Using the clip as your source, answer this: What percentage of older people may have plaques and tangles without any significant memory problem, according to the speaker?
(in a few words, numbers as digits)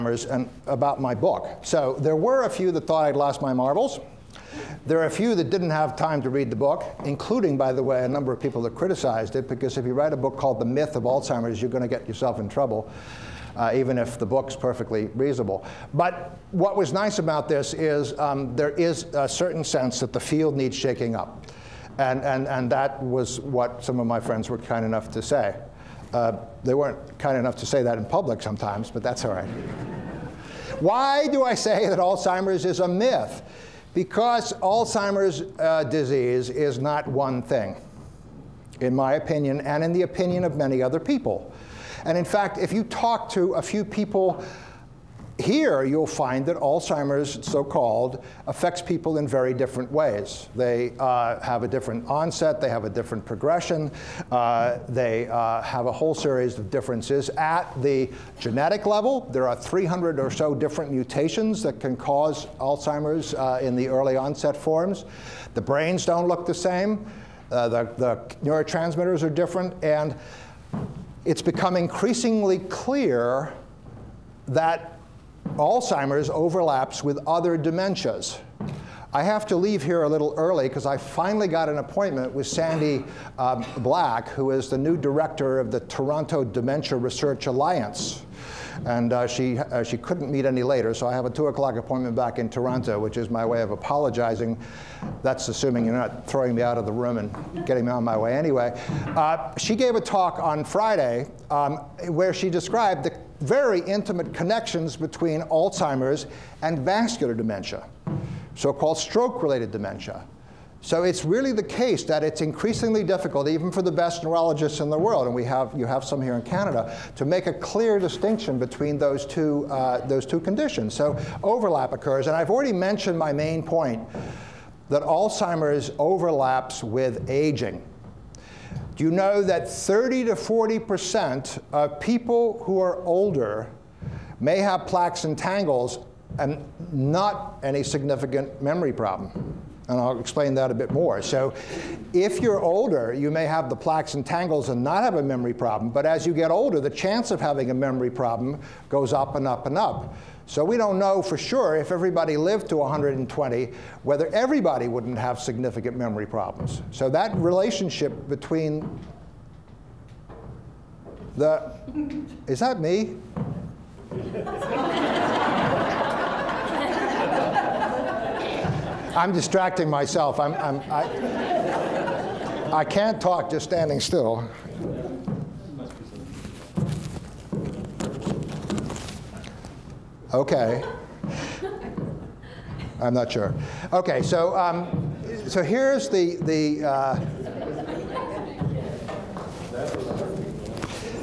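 30 to 40%.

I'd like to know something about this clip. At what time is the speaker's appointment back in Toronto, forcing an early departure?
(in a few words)
2 o'clock.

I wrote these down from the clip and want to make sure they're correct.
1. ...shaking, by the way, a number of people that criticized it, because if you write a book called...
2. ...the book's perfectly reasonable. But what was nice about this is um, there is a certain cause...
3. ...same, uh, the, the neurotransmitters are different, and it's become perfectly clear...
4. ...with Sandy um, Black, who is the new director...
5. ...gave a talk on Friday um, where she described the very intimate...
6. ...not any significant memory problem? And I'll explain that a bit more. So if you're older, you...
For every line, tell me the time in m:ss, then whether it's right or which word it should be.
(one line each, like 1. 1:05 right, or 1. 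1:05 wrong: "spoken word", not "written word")
1. 0:07 wrong: "including", not "shaking"
2. 0:14 wrong: "sense", not "cause"
3. 1:06 wrong: "increasingly", not "perfectly"
4. 1:22 right
5. 1:39 right
6. 2:16 right.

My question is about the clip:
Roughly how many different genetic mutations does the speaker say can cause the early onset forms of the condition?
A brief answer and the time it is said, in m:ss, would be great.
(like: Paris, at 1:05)
300, at 0:59.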